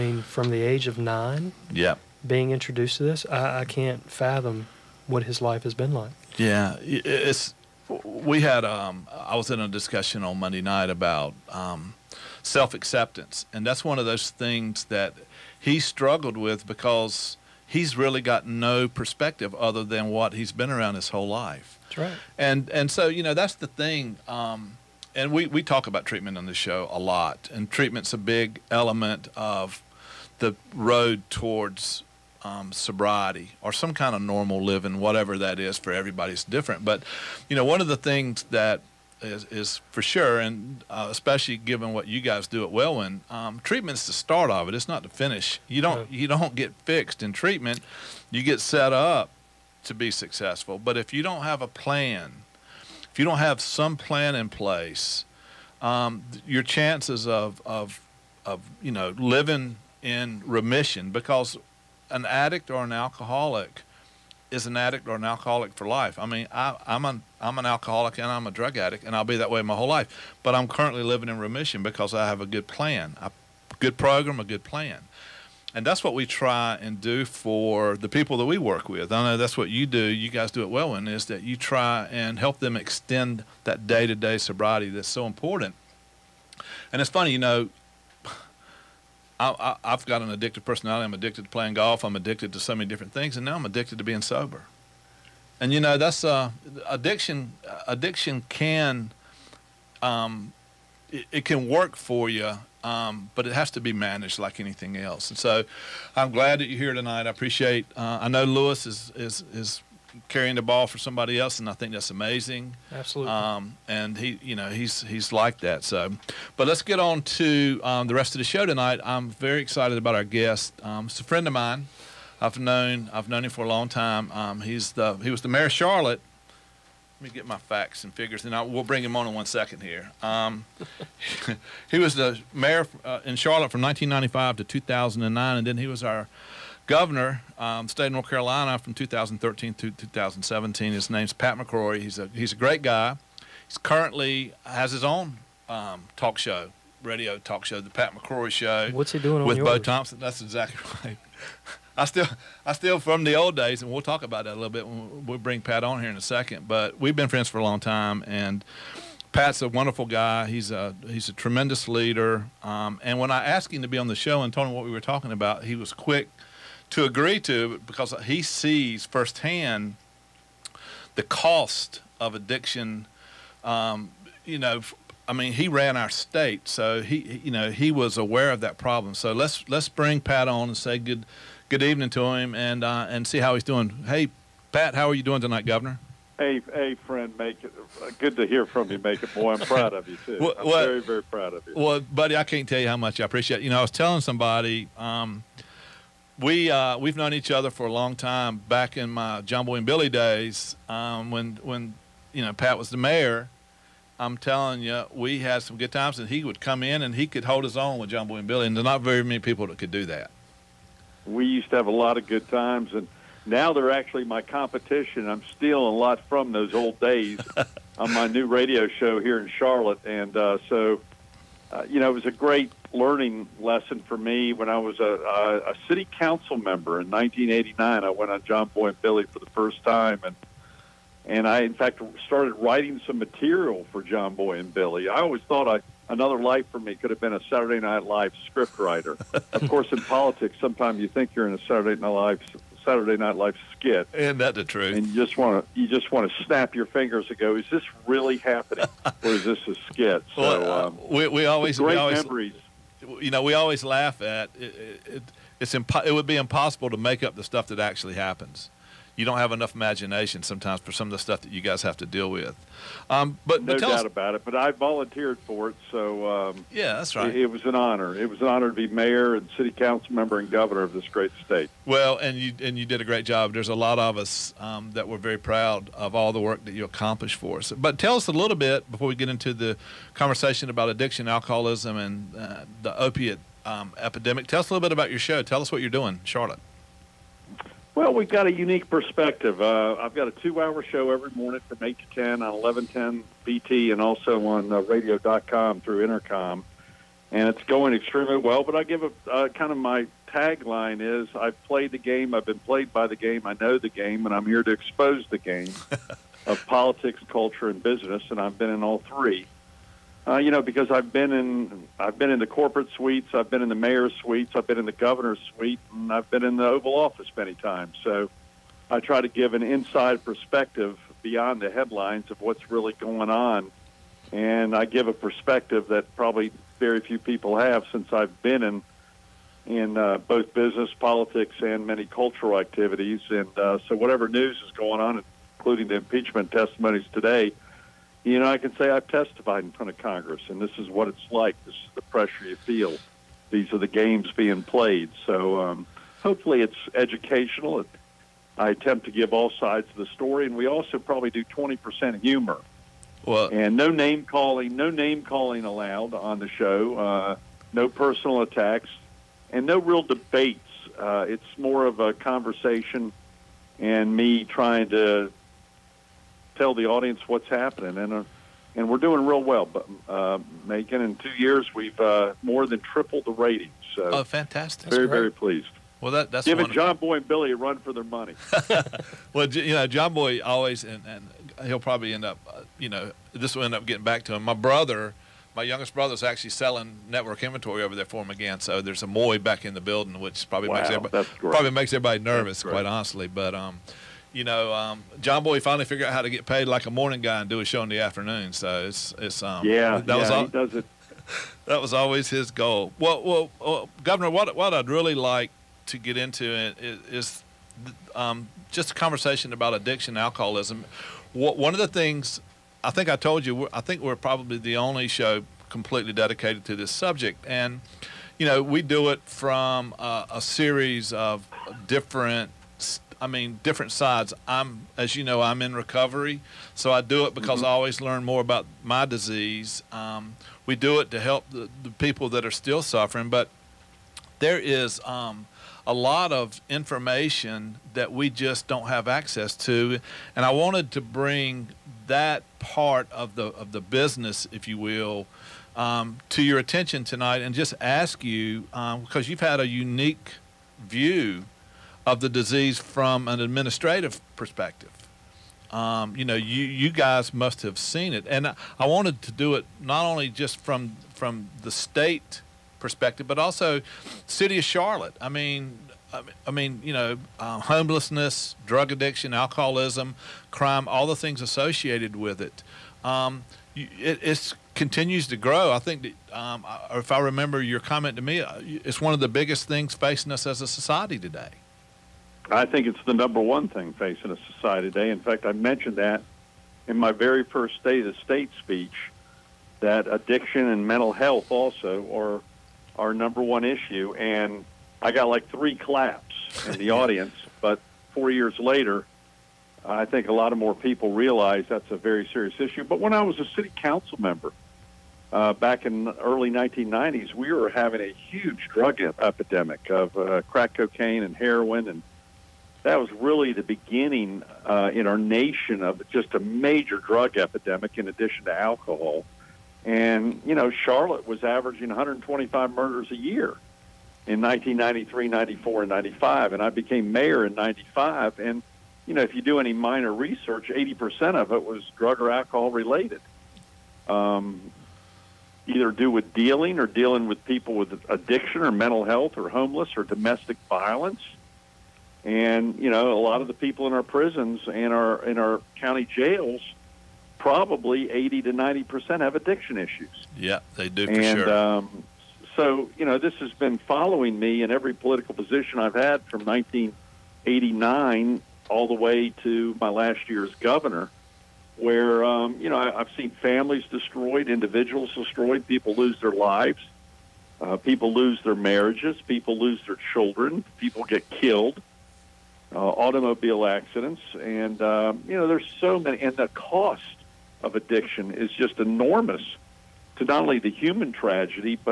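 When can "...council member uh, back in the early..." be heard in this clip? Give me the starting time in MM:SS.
08:23.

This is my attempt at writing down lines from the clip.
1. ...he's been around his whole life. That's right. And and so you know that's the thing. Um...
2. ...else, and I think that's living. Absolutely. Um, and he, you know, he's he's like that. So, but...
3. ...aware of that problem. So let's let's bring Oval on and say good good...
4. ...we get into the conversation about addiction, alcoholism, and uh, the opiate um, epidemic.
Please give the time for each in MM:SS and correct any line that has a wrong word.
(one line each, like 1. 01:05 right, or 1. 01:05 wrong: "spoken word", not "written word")
1. 00:20 right
2. 01:51 wrong: "amazing", not "living"
3. 02:58 wrong: "Pat", not "Oval"
4. 04:39 right.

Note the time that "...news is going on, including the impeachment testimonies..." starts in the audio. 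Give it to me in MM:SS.
05:34.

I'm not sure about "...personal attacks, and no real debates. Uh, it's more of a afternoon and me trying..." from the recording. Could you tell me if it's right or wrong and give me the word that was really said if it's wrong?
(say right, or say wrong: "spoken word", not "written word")
wrong: "conversation", not "afternoon".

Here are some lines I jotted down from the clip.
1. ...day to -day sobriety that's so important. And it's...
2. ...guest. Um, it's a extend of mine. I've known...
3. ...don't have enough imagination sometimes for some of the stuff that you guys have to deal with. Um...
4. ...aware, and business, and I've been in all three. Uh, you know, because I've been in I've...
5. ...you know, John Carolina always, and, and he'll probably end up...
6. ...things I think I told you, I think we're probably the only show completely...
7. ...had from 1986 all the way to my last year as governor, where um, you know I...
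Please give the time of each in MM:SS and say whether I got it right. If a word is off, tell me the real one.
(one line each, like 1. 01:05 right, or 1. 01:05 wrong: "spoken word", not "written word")
1. 01:23 right
2. 02:00 wrong: "friend", not "extend"
3. 04:19 right
4. 05:07 wrong: "culture", not "aware"
5. 06:19 wrong: "Boy", not "Carolina"
6. 06:51 right
7. 09:15 wrong: "1989", not "1986".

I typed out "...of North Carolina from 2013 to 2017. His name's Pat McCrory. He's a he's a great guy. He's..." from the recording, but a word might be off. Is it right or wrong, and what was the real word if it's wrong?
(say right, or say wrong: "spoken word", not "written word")
right.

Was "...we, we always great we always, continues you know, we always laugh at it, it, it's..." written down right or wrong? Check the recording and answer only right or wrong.
wrong.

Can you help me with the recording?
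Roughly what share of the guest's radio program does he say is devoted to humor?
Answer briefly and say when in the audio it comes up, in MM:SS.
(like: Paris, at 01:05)
20%, at 05:51.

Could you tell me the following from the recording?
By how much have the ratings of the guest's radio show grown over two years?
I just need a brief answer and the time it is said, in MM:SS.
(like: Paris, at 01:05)
more than tripled, at 06:12.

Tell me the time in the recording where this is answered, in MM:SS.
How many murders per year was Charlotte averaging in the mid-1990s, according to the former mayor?
08:41.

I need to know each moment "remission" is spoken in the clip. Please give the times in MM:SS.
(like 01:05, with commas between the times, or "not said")
01:00, 01:11.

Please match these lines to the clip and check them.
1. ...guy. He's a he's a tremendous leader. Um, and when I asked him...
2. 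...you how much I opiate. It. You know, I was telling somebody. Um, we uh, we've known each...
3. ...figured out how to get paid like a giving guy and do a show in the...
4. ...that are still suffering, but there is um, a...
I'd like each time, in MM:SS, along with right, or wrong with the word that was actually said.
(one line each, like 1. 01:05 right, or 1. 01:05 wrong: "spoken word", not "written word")
1. 02:40 right
2. 03:12 wrong: "appreciate", not "opiate"
3. 06:35 wrong: "morning", not "giving"
4. 07:12 right.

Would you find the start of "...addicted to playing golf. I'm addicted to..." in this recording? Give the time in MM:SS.
01:31.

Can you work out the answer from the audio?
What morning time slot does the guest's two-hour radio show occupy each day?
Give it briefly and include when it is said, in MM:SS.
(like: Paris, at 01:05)
8 to 10, at 04:51.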